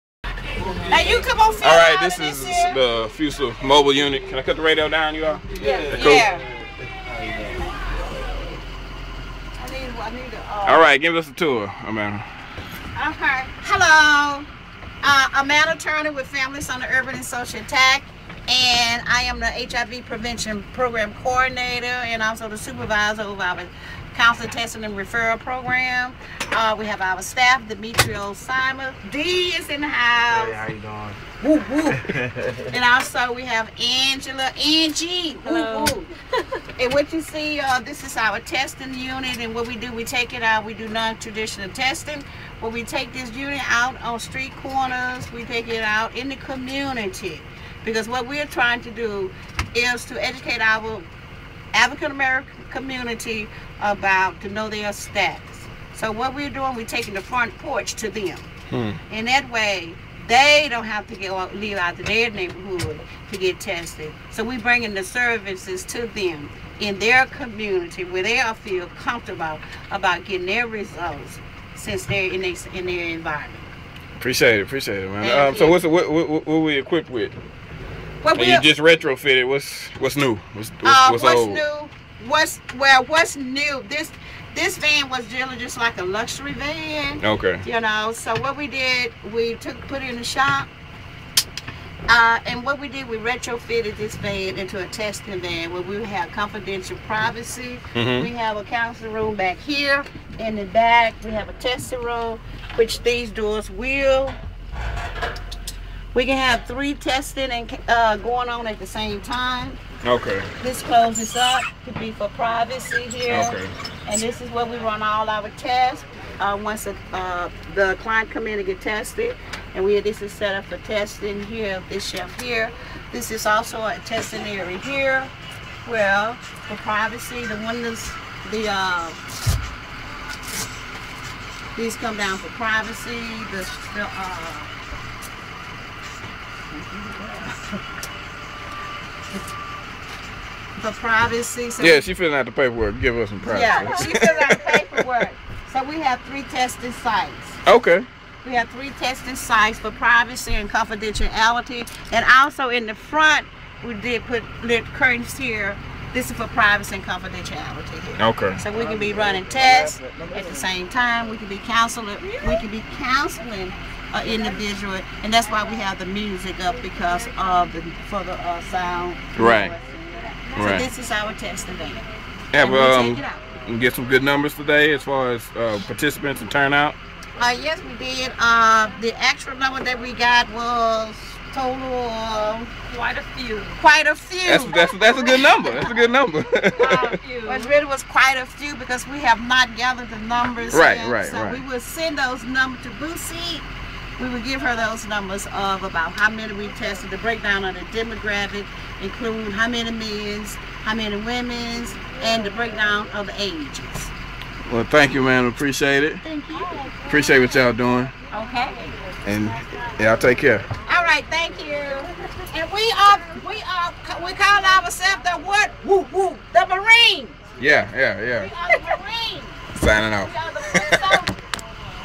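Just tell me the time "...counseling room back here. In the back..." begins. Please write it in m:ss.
1:38.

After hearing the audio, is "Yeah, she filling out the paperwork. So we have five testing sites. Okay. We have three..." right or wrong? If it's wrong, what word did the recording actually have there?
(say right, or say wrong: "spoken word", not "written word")
wrong: "three", not "five".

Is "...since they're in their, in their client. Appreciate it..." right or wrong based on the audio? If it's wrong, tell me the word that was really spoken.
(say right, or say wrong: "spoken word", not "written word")
wrong: "environment", not "client".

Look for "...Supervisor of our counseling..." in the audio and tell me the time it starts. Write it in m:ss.
0:22.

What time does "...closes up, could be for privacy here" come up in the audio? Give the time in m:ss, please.
1:50.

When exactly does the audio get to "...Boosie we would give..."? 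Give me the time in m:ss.
3:12.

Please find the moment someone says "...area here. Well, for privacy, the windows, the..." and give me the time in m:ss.
2:04.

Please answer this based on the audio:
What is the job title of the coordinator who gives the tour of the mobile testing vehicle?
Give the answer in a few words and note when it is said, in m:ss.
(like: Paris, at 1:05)
HIV Prevention Program Coordinator, at 0:19.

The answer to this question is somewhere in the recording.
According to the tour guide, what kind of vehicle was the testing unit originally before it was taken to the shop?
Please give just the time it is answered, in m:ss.
1:26.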